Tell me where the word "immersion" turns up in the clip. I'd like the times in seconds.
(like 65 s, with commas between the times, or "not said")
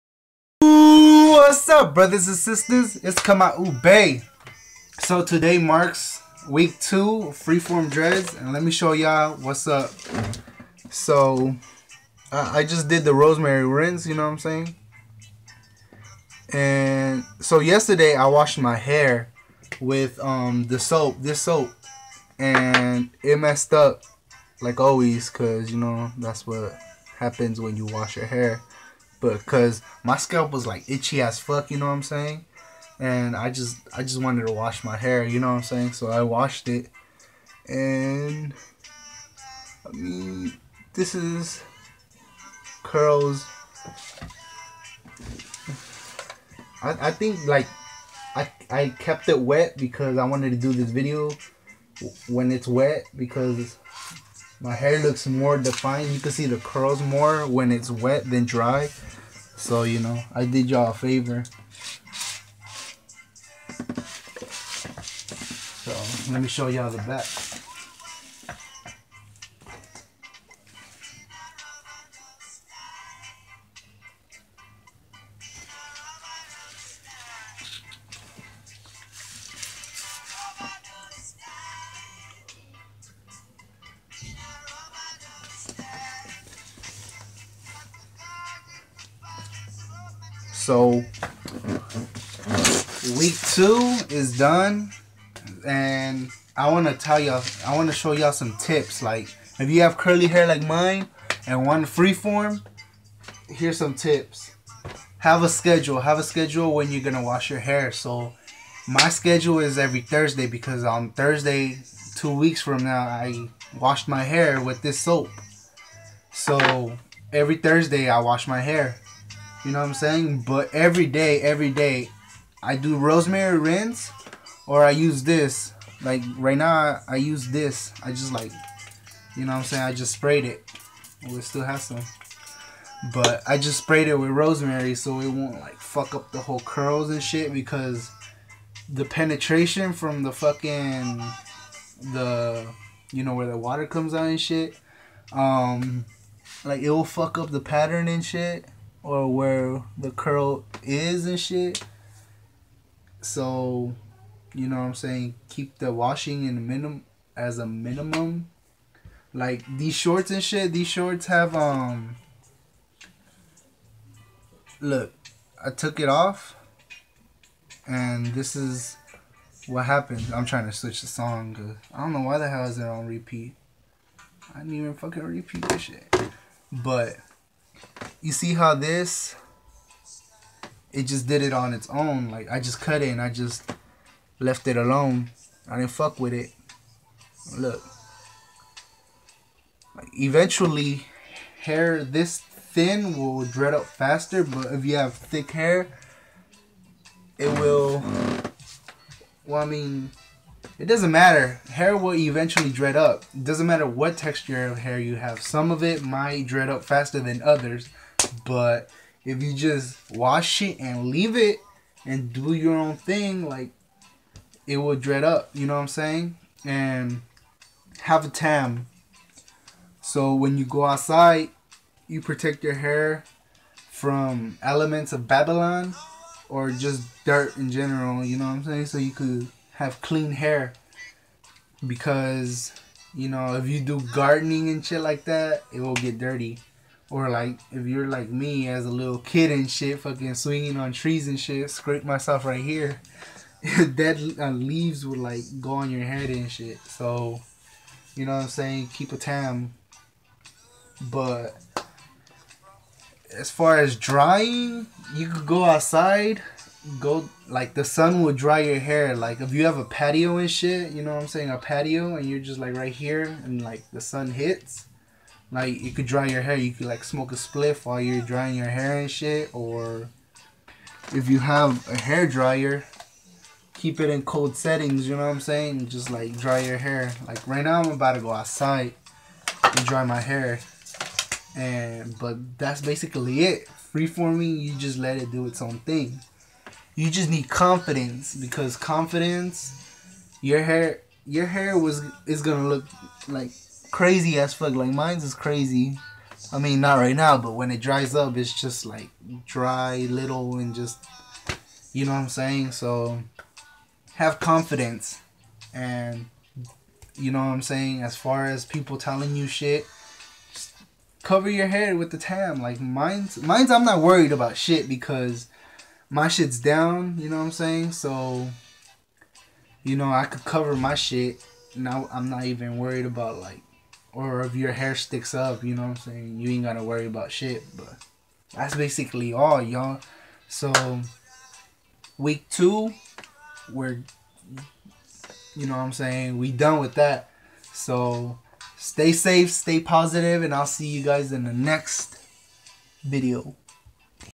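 not said.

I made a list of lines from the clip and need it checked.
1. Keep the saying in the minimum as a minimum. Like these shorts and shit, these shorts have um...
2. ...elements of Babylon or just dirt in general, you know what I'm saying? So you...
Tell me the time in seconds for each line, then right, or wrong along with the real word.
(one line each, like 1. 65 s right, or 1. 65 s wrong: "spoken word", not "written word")
1. 155 s wrong: "washing", not "saying"
2. 224 s right.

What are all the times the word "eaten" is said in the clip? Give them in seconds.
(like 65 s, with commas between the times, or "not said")
not said.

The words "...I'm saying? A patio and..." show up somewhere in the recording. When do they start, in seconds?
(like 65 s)
261 s.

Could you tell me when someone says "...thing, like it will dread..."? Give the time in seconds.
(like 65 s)
212 s.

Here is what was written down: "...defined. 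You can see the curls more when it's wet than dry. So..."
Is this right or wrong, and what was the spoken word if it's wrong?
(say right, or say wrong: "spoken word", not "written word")
right.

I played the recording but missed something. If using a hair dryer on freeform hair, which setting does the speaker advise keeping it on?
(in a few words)
Cold settings.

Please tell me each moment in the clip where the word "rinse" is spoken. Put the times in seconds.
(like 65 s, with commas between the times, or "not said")
13 s, 123 s.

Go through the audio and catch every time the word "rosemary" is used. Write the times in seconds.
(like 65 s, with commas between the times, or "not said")
13 s, 122 s, 134 s.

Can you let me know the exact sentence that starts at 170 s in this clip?
I'm trying to switch the song.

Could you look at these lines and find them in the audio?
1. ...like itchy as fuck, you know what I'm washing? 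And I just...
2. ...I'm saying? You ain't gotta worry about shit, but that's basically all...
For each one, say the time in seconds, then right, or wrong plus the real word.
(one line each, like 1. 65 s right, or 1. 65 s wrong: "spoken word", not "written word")
1. 30 s wrong: "saying", not "washing"
2. 325 s right.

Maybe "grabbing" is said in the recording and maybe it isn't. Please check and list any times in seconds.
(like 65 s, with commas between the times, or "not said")
not said.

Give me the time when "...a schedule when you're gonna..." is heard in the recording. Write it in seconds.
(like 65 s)
106 s.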